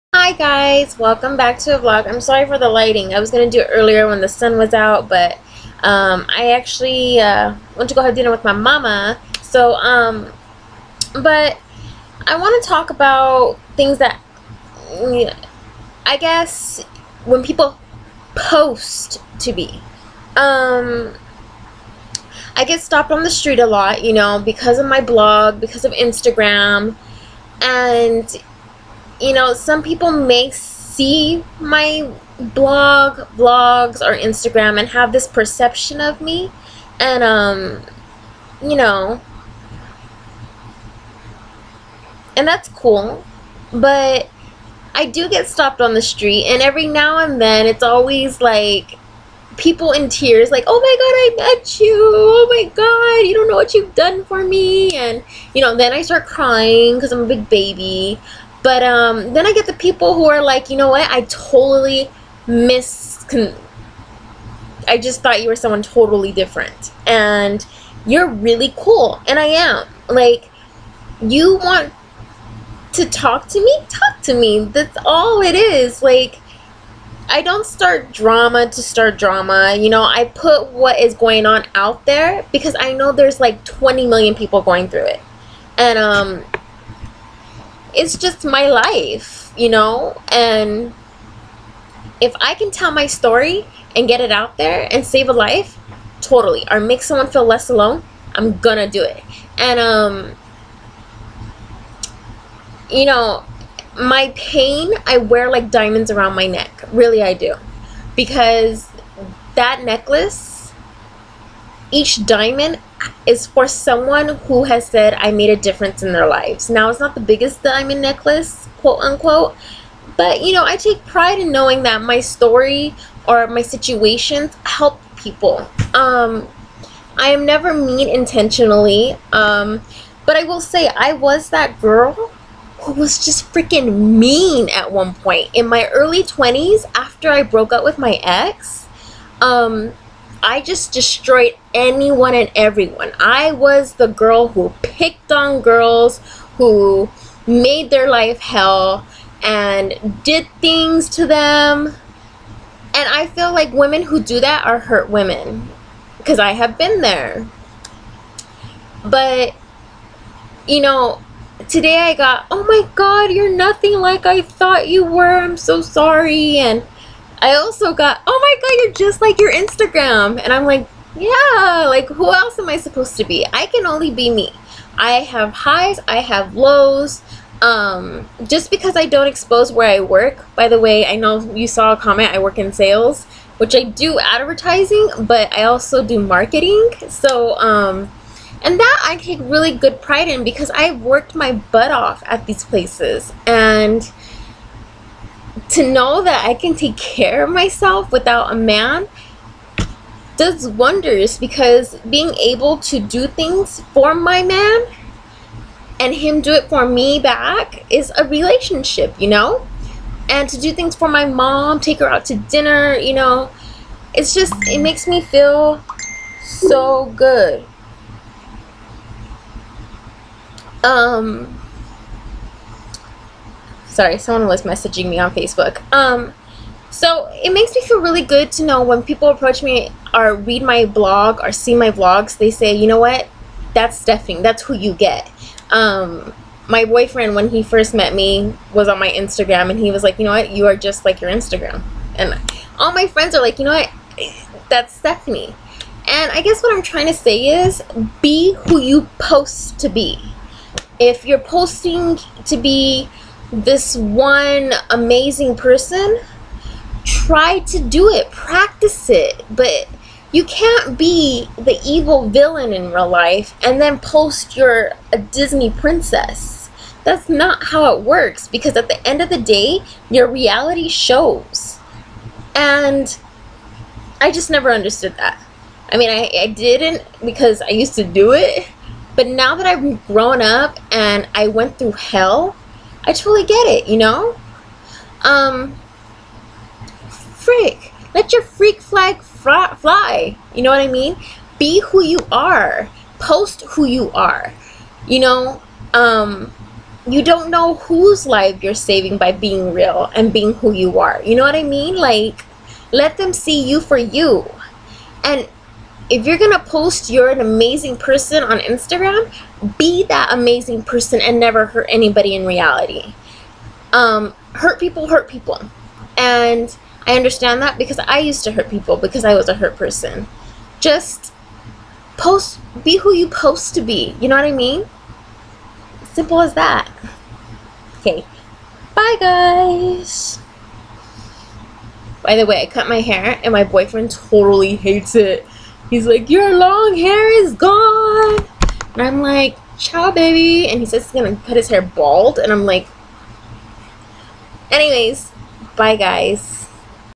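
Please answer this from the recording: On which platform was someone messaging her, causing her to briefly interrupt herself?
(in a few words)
Facebook.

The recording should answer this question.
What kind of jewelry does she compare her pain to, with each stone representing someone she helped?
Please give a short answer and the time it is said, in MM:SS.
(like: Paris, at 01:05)
Diamond necklace, at 01:57.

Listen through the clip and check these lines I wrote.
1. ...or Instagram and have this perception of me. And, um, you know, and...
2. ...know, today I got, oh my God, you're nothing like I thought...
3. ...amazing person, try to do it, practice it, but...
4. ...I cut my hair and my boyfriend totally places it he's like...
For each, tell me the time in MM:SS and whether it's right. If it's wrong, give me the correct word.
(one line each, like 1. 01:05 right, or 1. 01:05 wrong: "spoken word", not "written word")
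1. 00:34 right
2. 02:40 right
3. 04:14 right
4. 05:32 wrong: "hates", not "places".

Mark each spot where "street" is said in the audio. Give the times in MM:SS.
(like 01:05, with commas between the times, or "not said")
00:23, 00:46.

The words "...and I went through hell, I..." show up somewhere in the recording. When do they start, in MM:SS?
04:40.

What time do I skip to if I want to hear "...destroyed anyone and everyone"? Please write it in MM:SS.
02:20.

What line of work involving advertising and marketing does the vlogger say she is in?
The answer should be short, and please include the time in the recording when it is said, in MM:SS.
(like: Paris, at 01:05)
Sales, at 03:02.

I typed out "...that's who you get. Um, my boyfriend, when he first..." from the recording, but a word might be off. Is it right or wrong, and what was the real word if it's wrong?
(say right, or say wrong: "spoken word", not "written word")
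right.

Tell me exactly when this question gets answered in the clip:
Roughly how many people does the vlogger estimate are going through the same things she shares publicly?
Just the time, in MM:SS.
01:23.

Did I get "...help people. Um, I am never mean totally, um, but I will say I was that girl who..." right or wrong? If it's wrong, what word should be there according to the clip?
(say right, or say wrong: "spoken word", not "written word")
wrong: "intentionally", not "totally".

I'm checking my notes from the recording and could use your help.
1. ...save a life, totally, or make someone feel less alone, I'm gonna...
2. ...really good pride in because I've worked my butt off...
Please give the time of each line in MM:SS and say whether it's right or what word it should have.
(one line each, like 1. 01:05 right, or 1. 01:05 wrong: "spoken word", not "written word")
1. 01:35 right
2. 03:09 right.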